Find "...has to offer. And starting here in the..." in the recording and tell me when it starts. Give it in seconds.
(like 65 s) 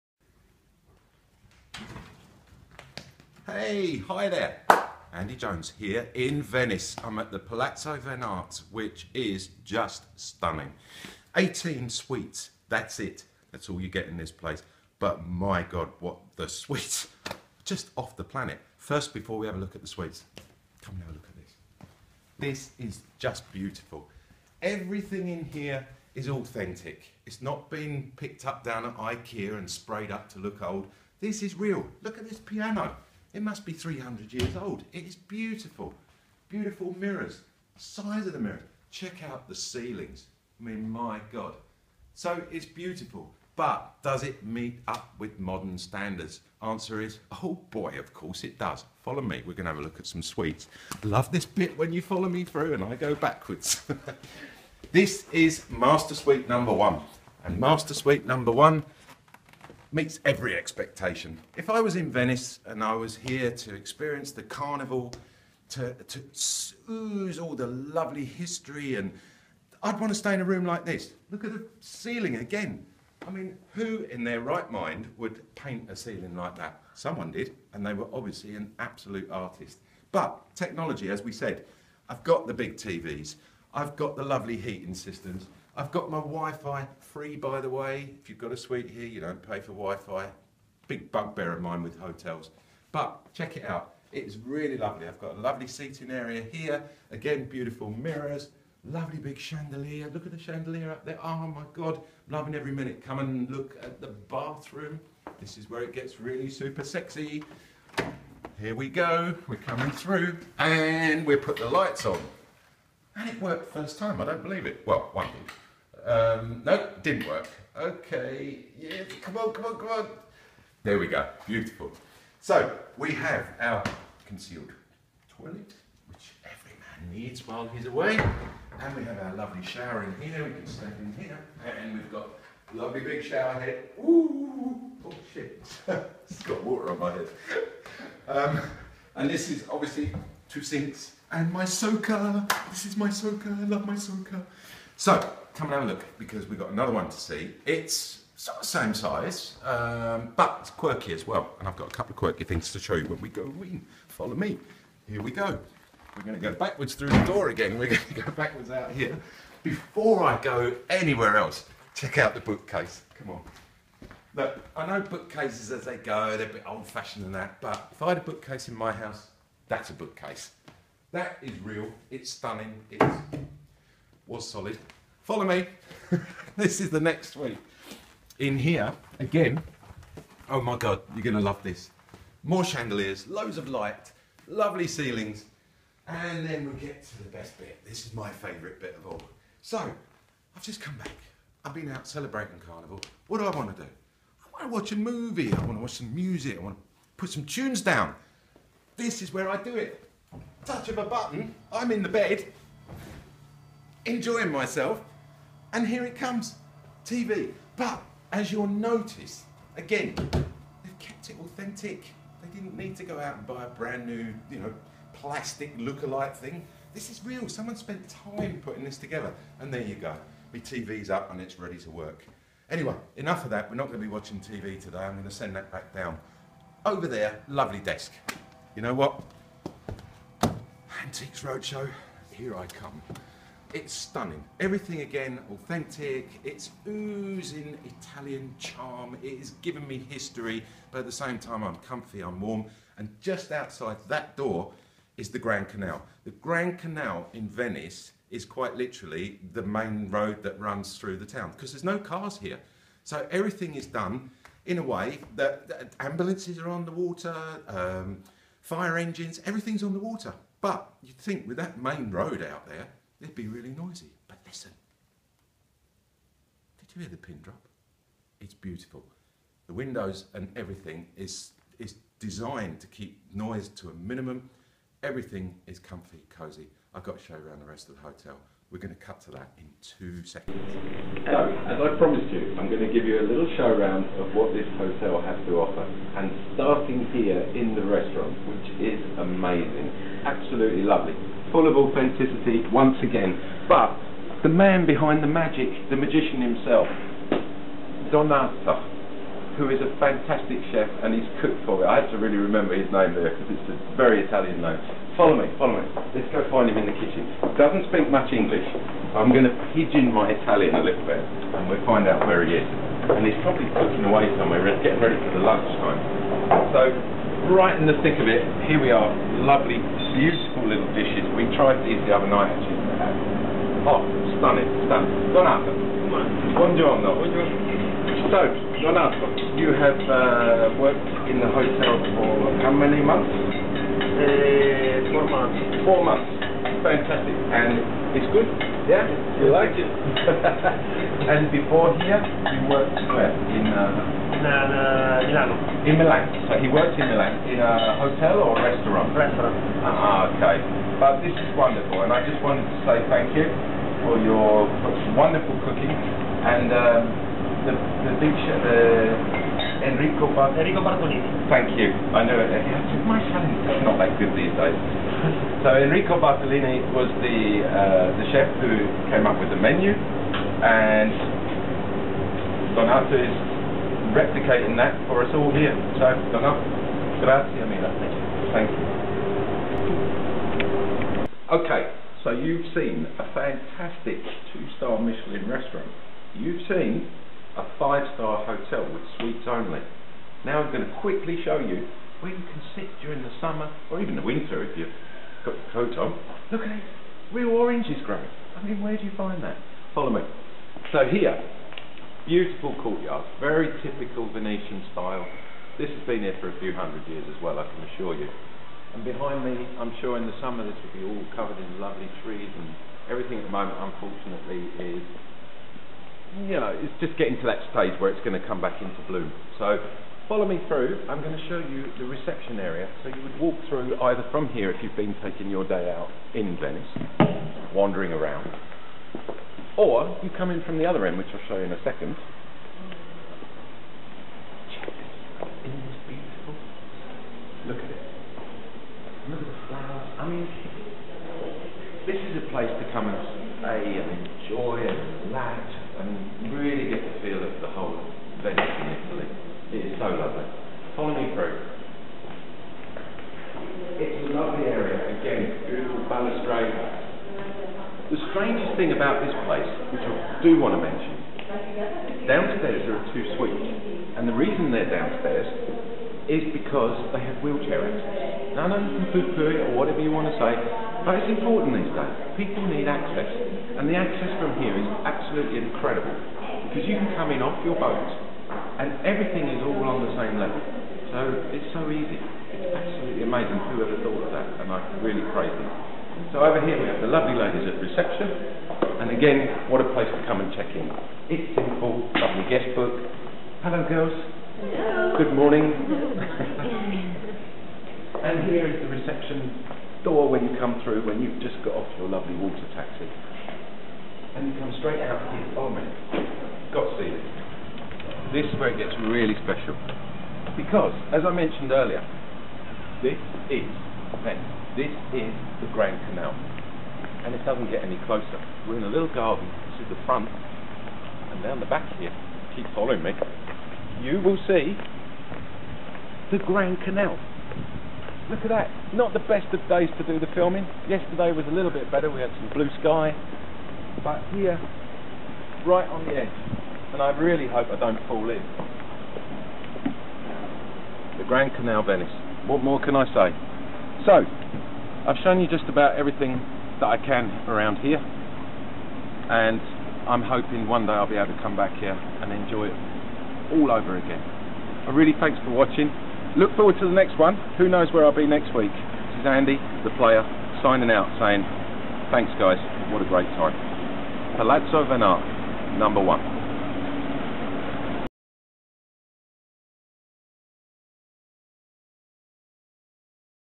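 285 s.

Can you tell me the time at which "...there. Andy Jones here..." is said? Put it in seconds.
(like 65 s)
4 s.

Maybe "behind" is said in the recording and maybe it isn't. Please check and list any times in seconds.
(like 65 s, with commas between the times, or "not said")
294 s, 409 s.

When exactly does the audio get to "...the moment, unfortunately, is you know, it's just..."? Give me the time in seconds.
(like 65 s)
413 s.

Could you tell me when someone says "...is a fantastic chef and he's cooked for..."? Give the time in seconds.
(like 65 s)
299 s.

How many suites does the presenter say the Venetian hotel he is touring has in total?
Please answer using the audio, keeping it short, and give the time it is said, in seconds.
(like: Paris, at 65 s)
18, at 11 s.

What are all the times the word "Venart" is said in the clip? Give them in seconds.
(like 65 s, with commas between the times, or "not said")
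7 s, 564 s.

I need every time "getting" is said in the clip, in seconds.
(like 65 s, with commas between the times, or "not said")
314 s, 417 s.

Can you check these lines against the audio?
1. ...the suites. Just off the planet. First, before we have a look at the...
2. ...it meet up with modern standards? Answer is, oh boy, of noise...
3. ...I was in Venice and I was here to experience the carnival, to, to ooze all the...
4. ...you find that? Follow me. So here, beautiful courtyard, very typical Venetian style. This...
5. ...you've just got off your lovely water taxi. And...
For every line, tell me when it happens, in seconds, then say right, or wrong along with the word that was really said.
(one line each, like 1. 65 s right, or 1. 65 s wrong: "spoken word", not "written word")
1. 16 s right
2. 44 s wrong: "course", not "noise"
3. 61 s right
4. 399 s right
5. 501 s right.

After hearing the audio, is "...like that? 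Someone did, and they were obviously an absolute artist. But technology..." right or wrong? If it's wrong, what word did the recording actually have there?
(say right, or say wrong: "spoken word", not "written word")
right.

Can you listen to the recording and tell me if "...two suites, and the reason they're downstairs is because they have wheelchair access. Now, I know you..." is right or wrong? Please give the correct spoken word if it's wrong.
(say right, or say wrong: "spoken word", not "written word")
right.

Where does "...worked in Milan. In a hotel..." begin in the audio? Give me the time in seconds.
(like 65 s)
346 s.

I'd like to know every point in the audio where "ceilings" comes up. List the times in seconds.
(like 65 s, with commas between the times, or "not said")
39 s, 71 s, 75 s, 184 s.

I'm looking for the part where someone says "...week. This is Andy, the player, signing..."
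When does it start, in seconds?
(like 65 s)
558 s.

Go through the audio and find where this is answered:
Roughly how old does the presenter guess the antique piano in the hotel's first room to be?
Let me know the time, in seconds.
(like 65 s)
33 s.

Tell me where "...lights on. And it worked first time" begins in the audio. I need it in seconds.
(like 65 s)
111 s.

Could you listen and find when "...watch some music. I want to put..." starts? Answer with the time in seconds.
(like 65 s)
195 s.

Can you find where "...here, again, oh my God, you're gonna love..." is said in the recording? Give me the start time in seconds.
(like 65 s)
178 s.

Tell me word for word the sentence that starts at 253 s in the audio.
So everything is done in a way that, that ambulances are on the water, um, fire engines, everything's on the water.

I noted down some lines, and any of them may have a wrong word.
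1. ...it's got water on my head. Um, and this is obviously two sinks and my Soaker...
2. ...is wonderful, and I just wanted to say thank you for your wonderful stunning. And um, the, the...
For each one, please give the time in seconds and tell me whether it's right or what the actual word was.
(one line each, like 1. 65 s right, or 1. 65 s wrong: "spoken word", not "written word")
1. 136 s right
2. 351 s wrong: "cooking", not "stunning".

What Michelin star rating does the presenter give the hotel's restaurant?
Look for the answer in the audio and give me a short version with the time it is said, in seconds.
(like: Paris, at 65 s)
two-star, at 384 s.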